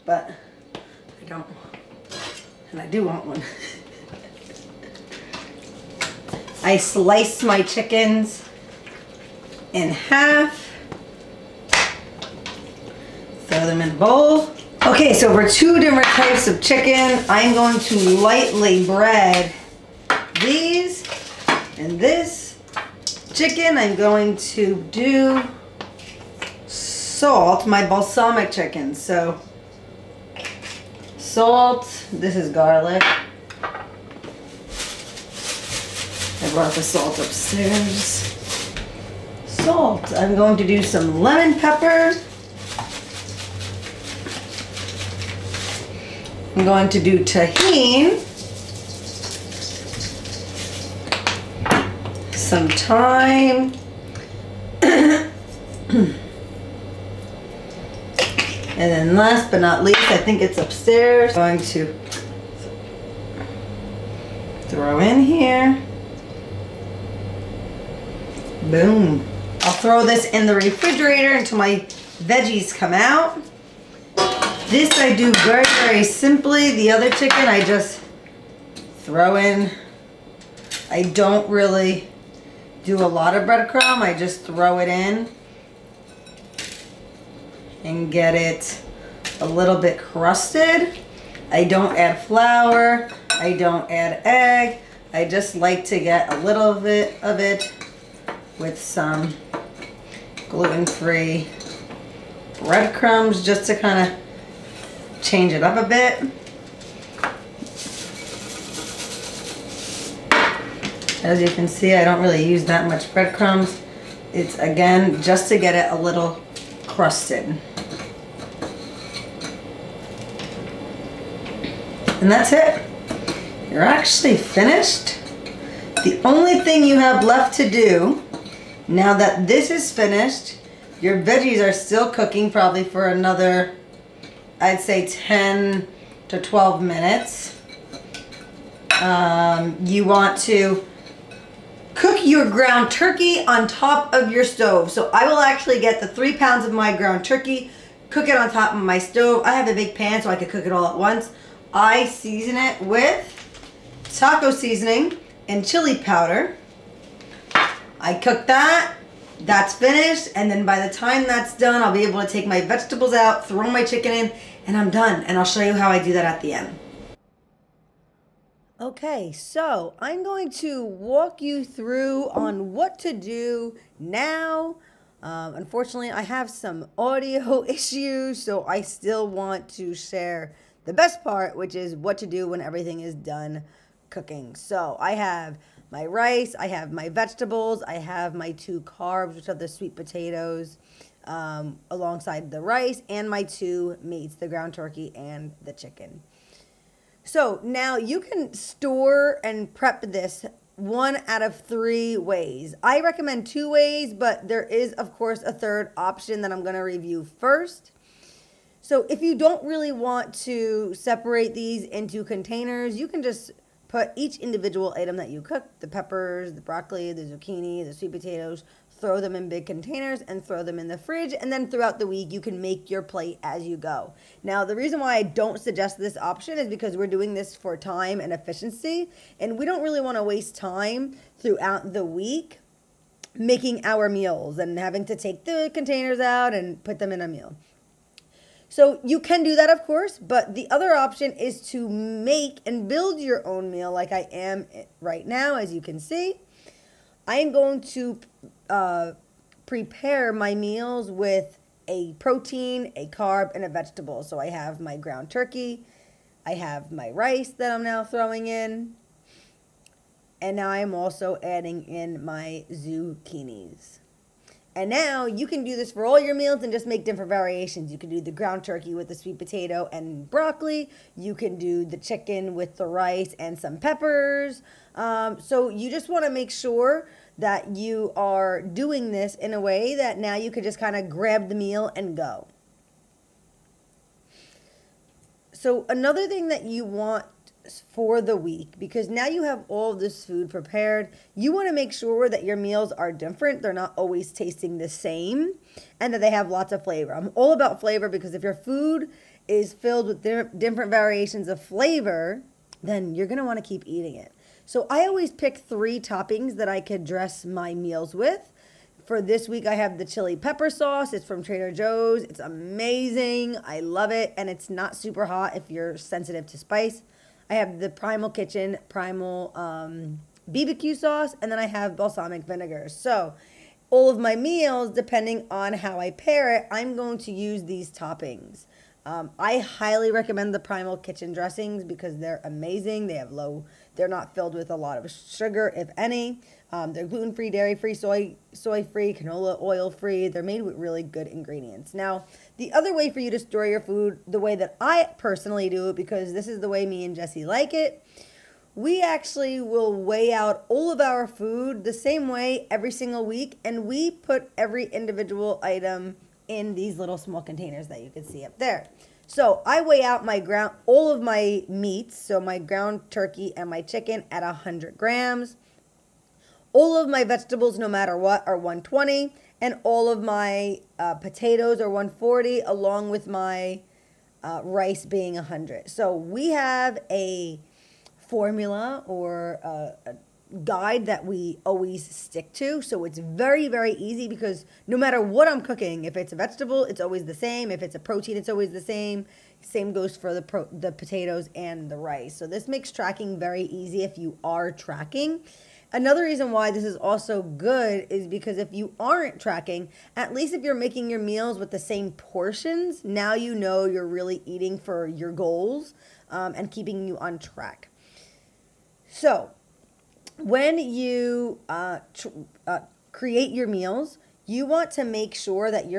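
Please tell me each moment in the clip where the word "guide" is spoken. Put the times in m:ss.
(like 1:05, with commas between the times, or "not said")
6:20.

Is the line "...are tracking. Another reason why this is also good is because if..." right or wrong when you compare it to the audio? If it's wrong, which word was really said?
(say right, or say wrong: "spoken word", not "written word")
right.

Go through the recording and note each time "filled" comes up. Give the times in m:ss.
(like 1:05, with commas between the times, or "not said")
4:59, 5:34.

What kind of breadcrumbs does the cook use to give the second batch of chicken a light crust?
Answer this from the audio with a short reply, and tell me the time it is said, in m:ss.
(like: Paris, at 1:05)
gluten-free breadcrumbs, at 1:40.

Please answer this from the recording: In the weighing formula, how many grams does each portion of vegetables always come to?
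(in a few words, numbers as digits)
120.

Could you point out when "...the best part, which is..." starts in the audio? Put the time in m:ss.
3:00.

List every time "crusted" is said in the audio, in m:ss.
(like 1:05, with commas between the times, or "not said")
1:29, 1:56.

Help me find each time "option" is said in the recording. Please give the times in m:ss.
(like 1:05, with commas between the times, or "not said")
3:25, 3:46, 4:00.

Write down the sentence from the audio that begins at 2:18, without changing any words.
Um, you want to cook your ground turkey on top of your stove.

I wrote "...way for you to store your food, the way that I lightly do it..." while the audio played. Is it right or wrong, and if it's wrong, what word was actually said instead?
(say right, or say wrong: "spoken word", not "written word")
wrong: "personally", not "lightly".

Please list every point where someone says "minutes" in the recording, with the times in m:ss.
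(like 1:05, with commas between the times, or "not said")
2:16.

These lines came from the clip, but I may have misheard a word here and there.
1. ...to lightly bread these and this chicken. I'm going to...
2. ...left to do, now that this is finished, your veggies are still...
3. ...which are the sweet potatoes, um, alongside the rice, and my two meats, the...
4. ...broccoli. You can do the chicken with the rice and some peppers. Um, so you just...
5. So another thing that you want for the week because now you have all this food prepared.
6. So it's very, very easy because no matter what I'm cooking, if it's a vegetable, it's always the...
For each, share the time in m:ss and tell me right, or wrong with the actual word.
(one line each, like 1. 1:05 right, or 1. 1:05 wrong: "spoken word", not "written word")
1. 0:17 right
2. 2:07 right
3. 3:09 right
4. 4:30 right
5. 4:45 right
6. 6:22 right.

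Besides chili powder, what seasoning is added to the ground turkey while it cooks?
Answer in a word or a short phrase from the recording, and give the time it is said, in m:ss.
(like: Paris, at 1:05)
taco seasoning, at 2:34.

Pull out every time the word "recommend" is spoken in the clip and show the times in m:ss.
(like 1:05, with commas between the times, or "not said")
3:22, 5:30.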